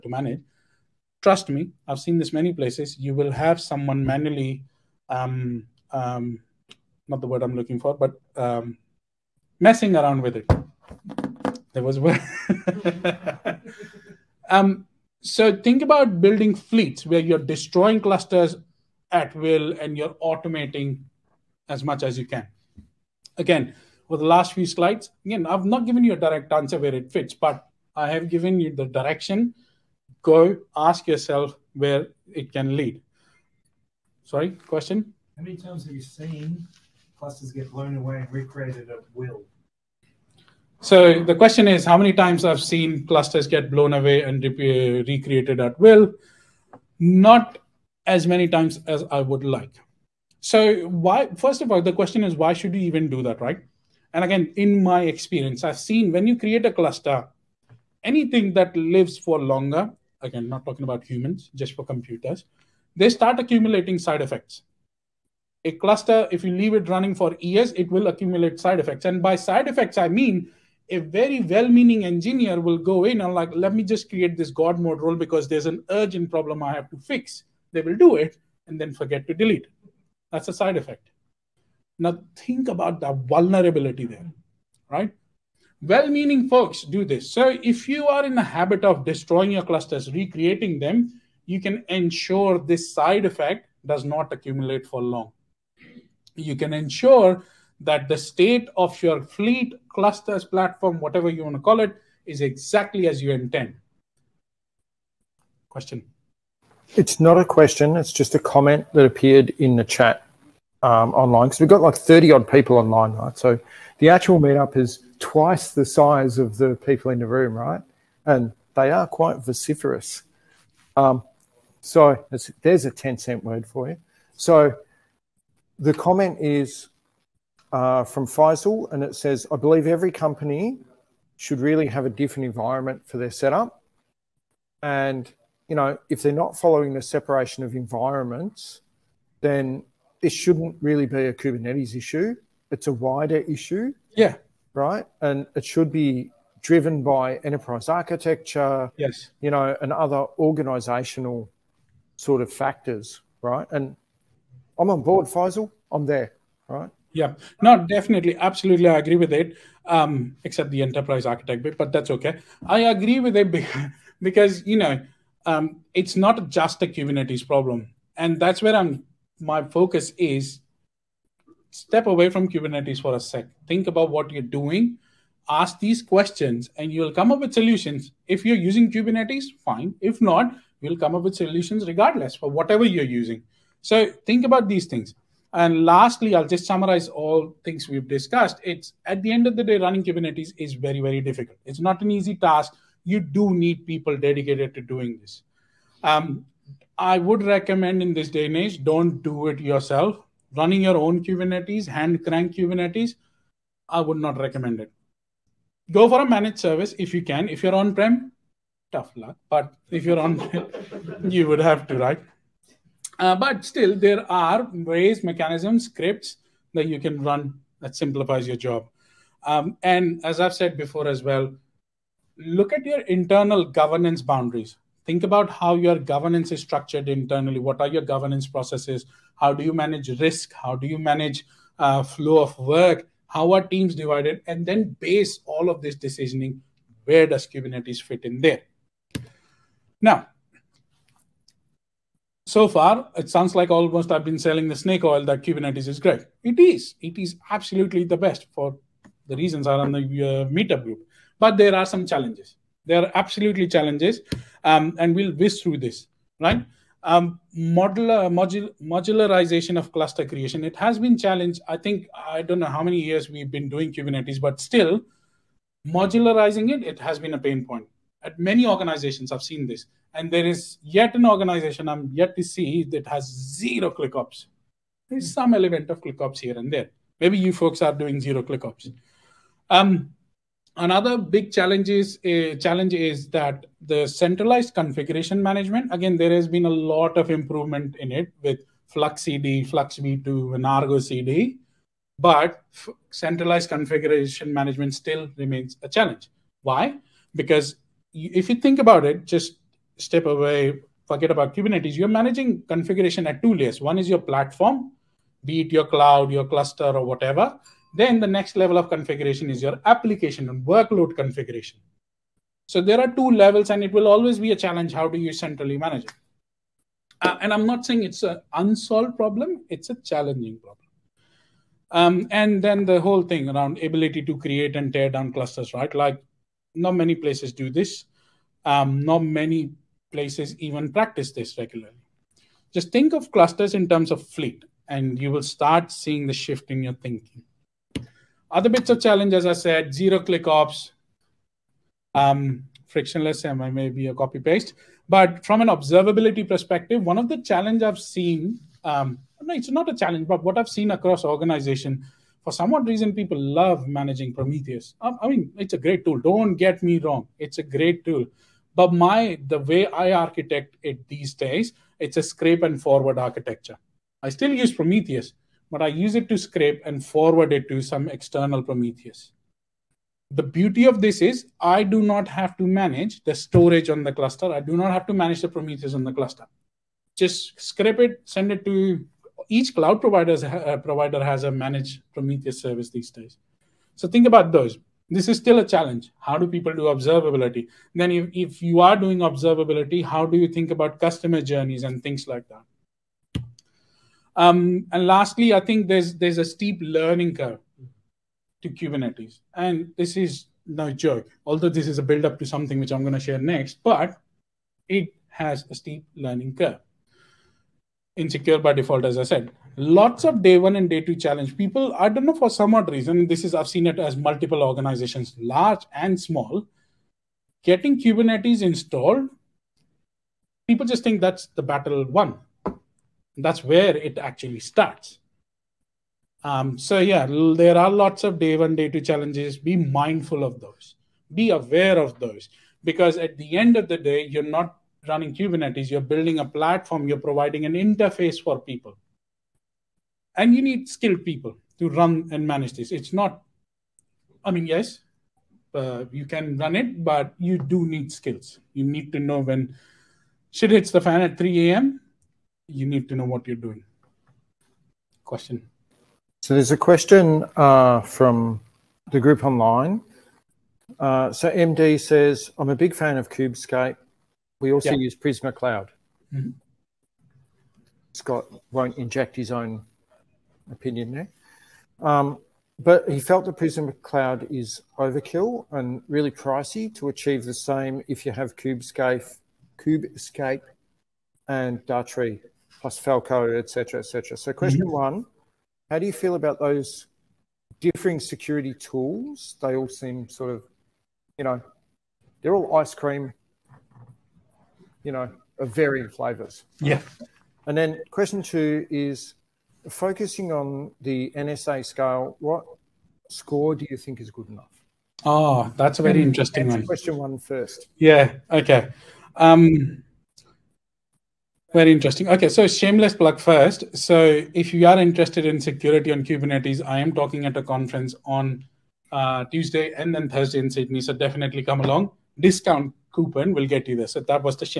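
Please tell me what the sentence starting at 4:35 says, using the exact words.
There's some element of ClickOps here and there.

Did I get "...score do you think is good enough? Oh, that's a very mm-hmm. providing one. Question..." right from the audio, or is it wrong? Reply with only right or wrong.
wrong.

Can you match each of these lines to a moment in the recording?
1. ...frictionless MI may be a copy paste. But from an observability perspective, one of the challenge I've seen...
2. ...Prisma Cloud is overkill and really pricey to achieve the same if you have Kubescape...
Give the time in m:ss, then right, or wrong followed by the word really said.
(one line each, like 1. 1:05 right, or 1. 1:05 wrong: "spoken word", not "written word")
1. 5:42 right
2. 7:53 right.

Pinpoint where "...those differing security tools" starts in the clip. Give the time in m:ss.
8:06.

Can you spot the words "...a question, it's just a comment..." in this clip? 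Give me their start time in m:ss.
1:47.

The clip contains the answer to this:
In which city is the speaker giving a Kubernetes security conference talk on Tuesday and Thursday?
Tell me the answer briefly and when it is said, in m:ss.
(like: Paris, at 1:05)
Sydney, at 8:40.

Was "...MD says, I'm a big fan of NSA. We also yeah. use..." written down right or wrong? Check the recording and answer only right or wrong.
wrong.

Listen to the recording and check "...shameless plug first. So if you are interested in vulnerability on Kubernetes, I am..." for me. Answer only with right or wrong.
wrong.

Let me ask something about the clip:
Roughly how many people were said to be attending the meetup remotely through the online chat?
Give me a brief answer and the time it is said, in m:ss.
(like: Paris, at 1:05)
30, at 1:51.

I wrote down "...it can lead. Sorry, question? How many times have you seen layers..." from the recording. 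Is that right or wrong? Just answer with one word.
wrong.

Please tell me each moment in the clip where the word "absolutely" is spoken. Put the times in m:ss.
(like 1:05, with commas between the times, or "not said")
2:38, 4:07, 4:13.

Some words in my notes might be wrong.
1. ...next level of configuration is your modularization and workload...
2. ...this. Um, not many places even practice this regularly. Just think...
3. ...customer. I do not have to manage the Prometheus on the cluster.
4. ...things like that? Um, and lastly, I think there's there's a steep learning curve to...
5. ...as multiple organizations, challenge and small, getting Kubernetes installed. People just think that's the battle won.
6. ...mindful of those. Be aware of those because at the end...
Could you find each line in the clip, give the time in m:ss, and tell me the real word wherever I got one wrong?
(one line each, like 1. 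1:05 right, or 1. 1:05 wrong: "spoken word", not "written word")
1. 5:08 wrong: "application", not "modularization"
2. 5:27 right
3. 6:14 wrong: "cluster", not "customer"
4. 6:32 right
5. 6:53 wrong: "large", not "challenge"
6. 7:09 right.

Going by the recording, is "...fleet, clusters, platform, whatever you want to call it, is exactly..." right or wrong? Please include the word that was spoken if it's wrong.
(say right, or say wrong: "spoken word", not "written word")
right.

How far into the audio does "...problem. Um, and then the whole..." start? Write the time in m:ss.
5:20.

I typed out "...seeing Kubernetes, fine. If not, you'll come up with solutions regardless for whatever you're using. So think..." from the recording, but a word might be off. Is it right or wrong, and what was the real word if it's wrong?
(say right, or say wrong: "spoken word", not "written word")
wrong: "using", not "seeing".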